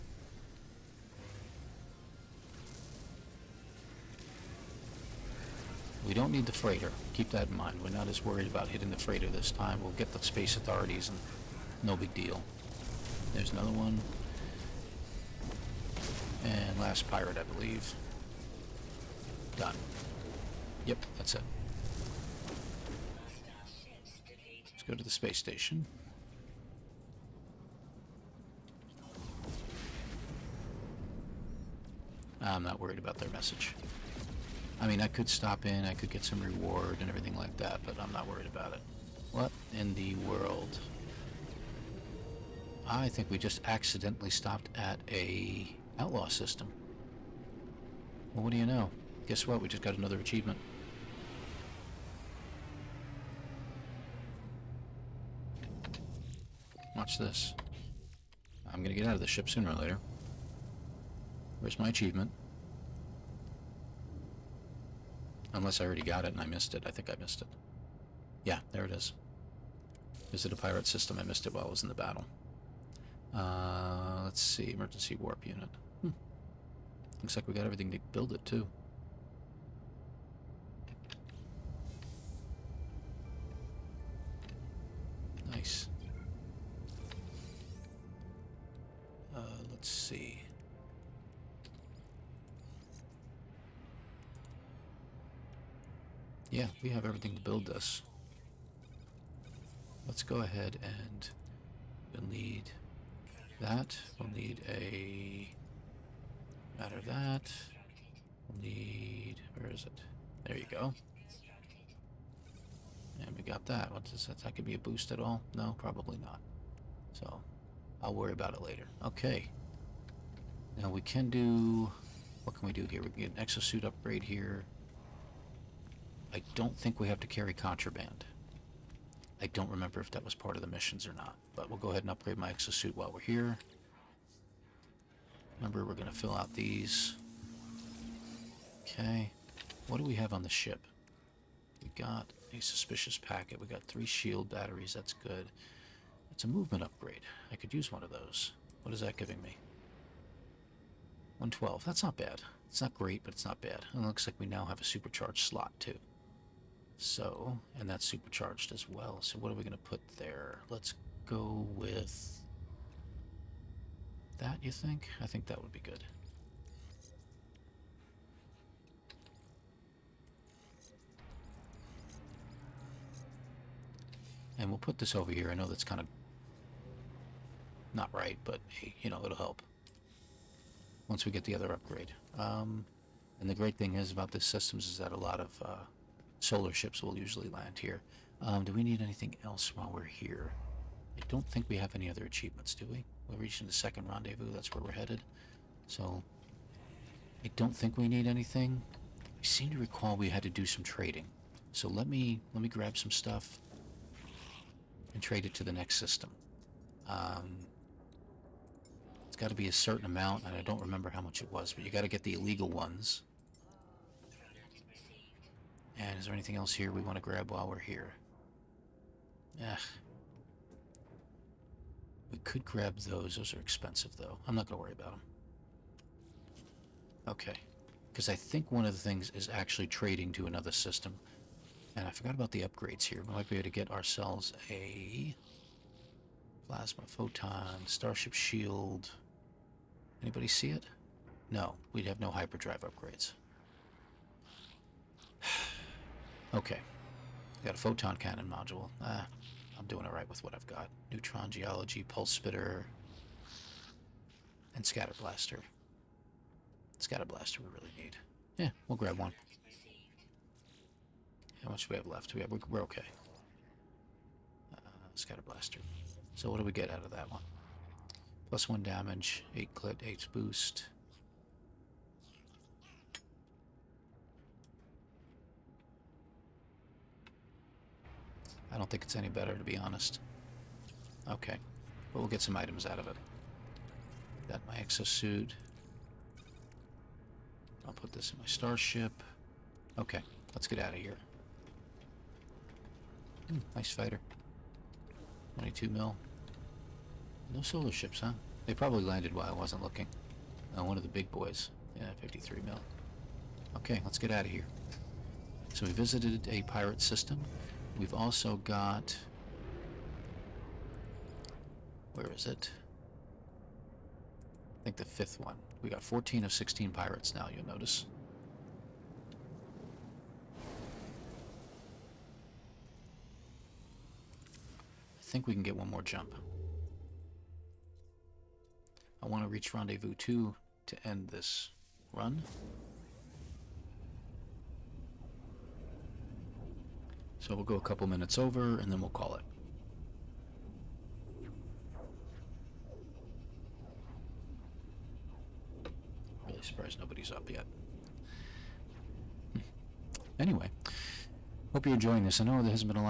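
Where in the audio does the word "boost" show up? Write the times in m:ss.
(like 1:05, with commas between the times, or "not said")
1:54, 4:30.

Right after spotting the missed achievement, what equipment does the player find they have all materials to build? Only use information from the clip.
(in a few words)
Emergency warp unit.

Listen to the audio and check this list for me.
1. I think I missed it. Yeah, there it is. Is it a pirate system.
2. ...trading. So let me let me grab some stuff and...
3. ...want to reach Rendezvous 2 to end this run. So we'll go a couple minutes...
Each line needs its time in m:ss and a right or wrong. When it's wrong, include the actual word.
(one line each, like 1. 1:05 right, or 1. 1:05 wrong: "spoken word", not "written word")
1. 1:06 right
2. 3:20 right
3. 5:29 right.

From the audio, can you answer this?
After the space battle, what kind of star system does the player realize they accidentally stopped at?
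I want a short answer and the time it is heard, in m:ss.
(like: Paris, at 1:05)
Outlaw system, at 0:45.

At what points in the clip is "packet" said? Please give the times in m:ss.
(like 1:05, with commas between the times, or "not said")
2:23.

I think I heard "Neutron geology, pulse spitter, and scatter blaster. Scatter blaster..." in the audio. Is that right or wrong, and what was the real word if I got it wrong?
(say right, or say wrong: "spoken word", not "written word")
right.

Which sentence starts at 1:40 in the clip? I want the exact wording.
Let's go ahead and we'll need that.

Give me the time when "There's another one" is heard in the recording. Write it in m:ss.
0:13.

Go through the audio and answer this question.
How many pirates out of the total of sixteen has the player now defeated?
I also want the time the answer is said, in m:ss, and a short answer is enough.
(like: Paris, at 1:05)
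14, at 5:16.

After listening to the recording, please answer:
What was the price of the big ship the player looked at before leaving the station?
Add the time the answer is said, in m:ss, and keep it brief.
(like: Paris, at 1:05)
53 mil, at 5:02.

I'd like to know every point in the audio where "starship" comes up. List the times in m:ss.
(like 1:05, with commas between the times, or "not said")
3:57, 4:48.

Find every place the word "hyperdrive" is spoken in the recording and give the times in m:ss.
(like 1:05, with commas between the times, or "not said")
4:02.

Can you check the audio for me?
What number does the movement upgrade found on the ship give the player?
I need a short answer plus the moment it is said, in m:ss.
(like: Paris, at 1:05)
112, at 2:31.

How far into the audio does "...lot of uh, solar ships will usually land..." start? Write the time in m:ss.
3:05.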